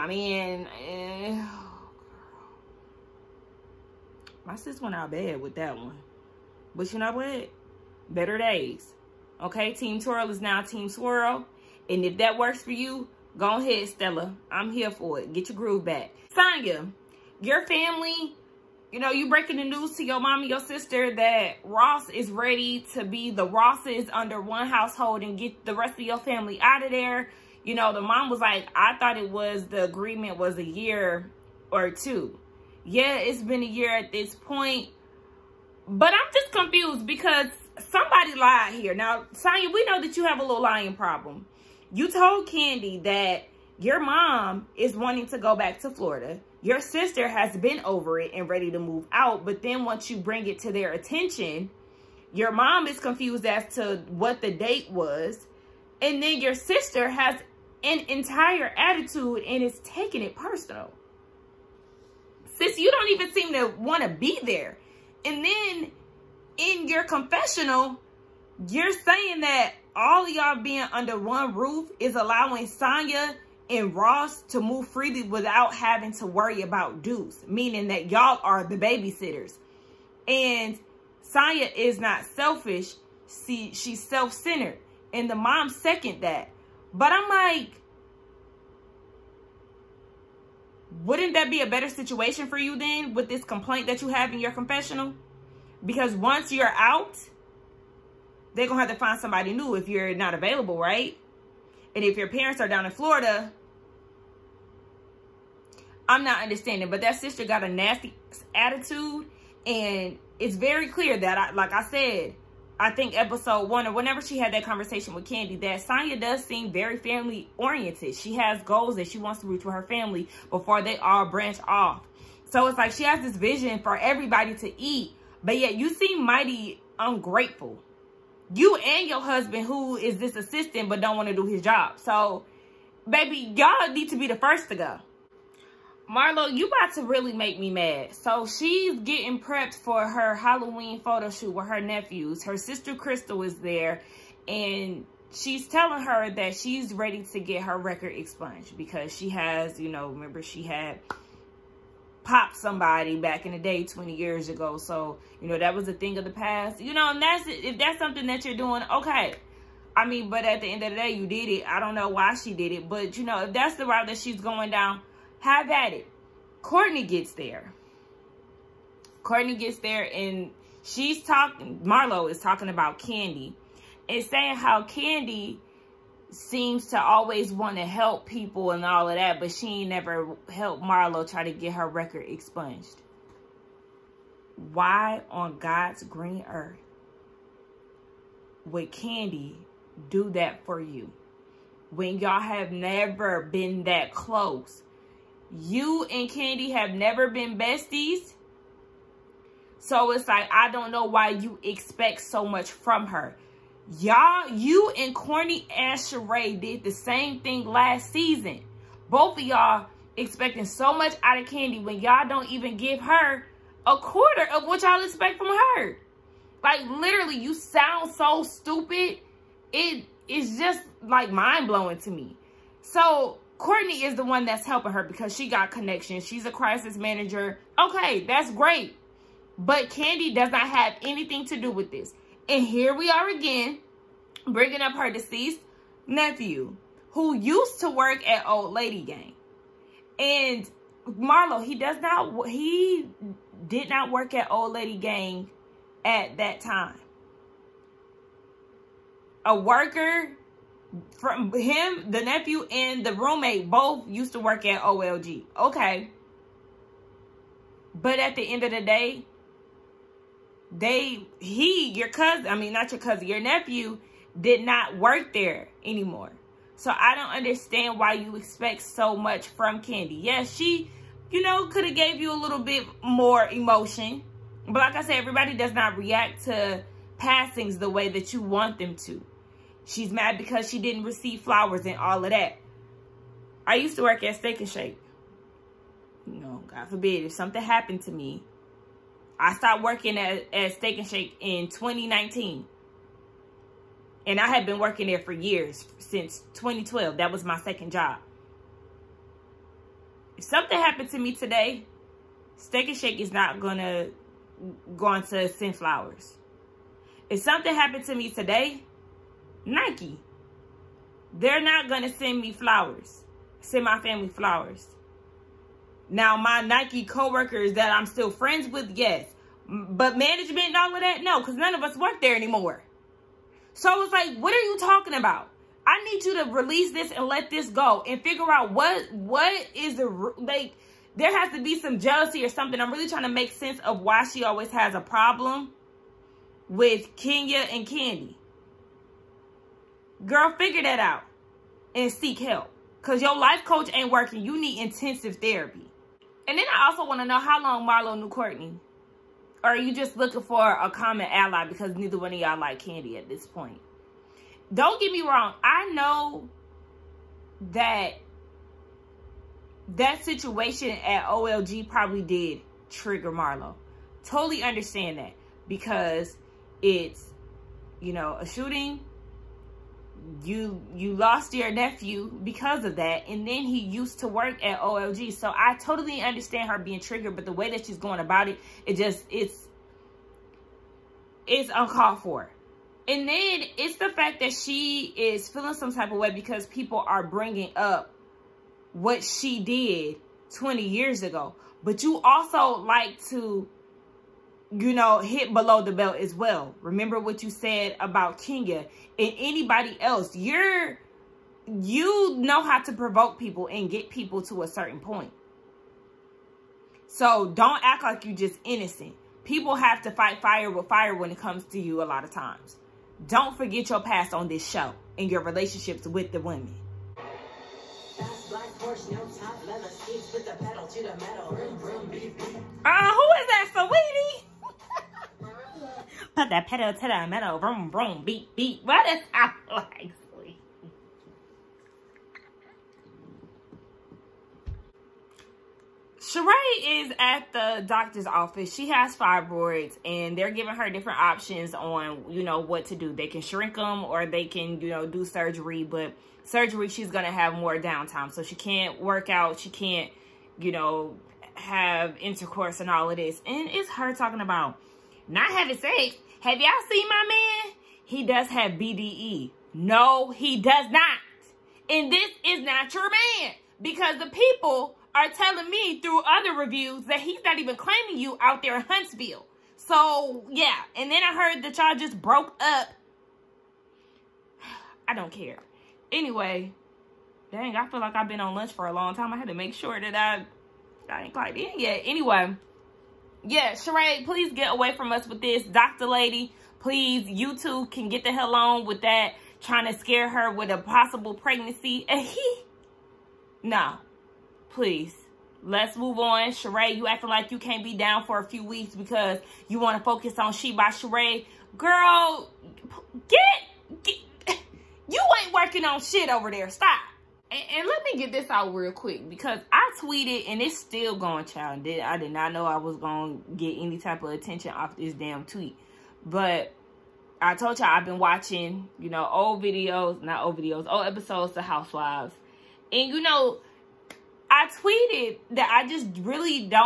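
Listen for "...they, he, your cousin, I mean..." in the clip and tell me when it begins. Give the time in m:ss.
4:20.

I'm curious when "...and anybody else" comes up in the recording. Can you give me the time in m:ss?
6:39.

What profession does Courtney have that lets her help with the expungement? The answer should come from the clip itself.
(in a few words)
Crisis manager.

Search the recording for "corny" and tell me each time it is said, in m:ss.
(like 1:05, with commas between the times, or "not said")
3:25.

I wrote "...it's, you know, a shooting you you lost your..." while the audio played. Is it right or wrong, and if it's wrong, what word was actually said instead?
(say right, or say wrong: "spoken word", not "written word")
right.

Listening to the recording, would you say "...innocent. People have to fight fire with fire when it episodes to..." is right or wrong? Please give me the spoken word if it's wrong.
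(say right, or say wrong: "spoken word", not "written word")
wrong: "comes", not "episodes".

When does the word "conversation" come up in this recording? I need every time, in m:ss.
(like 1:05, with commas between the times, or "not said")
1:54.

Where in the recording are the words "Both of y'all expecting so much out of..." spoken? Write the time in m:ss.
3:29.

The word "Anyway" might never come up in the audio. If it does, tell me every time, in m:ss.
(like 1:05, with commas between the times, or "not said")
7:56, 8:02.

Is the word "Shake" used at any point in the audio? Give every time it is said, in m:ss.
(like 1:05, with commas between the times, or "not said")
4:44, 4:51, 5:02.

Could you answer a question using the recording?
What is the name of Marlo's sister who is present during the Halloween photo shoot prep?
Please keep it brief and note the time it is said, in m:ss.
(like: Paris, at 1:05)
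Crystal, at 2:22.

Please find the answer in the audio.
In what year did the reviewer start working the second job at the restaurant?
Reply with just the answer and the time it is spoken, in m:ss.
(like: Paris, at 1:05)
2012, at 4:56.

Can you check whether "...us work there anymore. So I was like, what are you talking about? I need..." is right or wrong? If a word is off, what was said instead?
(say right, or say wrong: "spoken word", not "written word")
right.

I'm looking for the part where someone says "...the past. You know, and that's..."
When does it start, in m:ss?
2:36.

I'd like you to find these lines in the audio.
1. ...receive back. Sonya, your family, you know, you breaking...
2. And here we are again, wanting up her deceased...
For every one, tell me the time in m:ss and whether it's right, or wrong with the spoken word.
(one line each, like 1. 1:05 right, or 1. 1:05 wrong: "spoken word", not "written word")
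1. 0:15 wrong: "groove", not "receive"
2. 3:52 wrong: "bringing", not "wanting".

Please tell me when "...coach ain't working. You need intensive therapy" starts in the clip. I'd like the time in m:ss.
5:43.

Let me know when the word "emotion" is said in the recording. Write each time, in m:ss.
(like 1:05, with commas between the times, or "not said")
4:33.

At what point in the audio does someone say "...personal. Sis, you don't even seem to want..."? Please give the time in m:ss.
1:00.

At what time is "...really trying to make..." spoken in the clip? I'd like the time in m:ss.
5:32.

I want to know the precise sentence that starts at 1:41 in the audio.
And if your parents are down in Florida, I'm not understanding.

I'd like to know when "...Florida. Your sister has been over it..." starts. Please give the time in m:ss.
0:45.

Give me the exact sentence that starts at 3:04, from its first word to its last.
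Why on God's green earth would Kandi do that for you when y'all have never been that close?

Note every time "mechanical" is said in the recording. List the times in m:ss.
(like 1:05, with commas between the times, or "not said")
not said.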